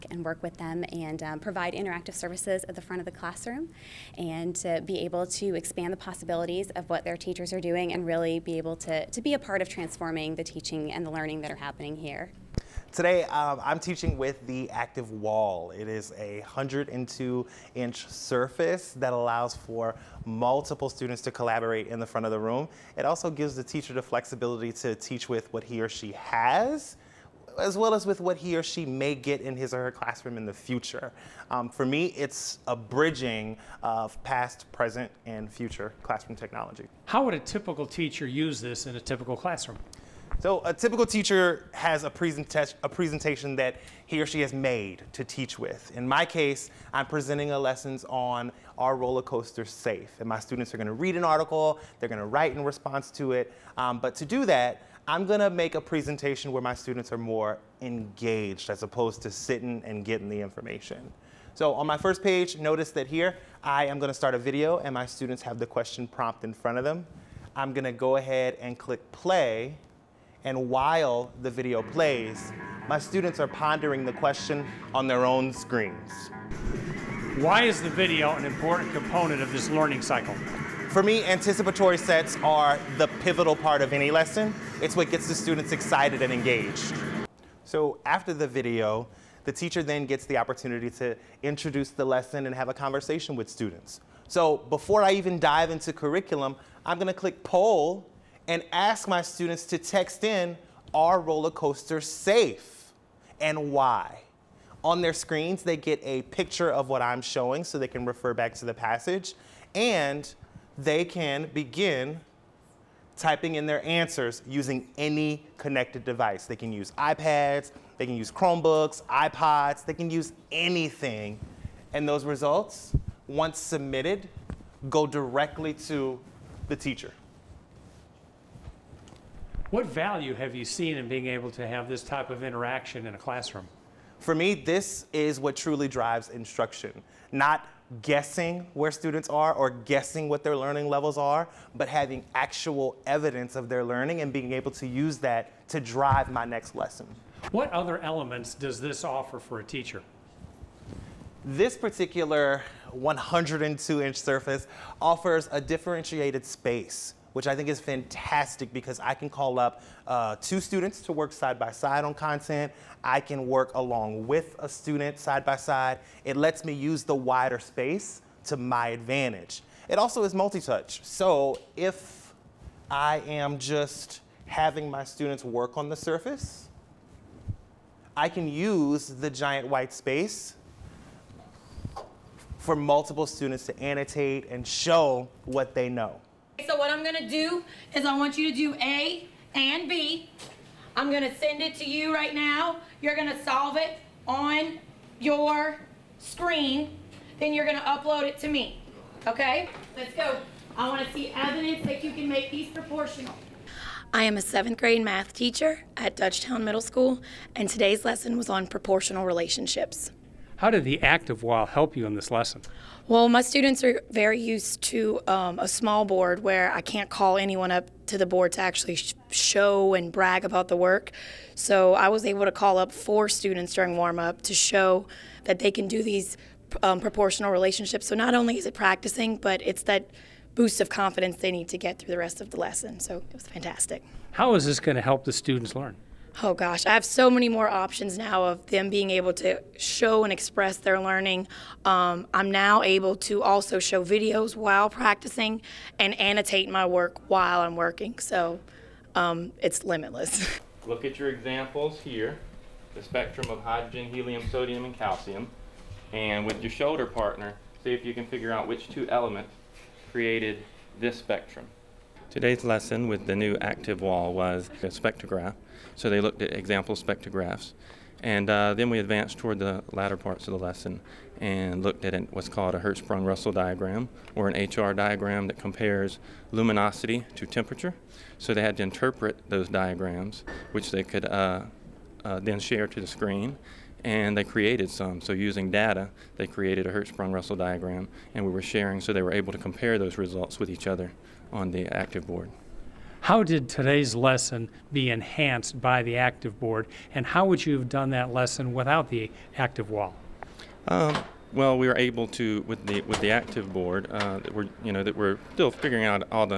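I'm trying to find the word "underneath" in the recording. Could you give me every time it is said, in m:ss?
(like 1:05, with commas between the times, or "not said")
not said.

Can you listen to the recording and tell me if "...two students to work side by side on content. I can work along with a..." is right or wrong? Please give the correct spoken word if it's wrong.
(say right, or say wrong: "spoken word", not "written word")
right.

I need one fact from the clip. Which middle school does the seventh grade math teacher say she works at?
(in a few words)
Dutchtown Middle School.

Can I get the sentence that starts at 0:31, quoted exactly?
Um, for me, it's a bridging of past, present, and future classroom technology.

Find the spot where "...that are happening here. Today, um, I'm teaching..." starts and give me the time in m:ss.
0:11.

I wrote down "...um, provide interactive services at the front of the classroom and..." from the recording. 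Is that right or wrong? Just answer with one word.
right.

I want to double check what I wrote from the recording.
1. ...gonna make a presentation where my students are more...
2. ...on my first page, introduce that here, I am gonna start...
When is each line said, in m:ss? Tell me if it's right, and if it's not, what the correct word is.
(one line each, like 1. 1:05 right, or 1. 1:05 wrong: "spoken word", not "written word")
1. 0:55 right
2. 1:01 wrong: "notice", not "introduce".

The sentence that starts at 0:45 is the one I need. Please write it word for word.
In my case, I'm presenting a lessons on our roller coaster safe.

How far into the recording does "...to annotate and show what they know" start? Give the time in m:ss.
3:03.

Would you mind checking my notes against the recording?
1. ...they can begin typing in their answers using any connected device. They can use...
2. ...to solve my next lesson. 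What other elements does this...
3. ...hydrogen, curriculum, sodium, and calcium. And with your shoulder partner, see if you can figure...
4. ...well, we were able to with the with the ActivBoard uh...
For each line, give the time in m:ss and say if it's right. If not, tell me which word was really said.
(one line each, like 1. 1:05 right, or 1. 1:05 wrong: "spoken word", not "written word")
1. 1:50 right
2. 2:25 wrong: "drive", not "solve"
3. 4:13 wrong: "helium", not "curriculum"
4. 5:01 right.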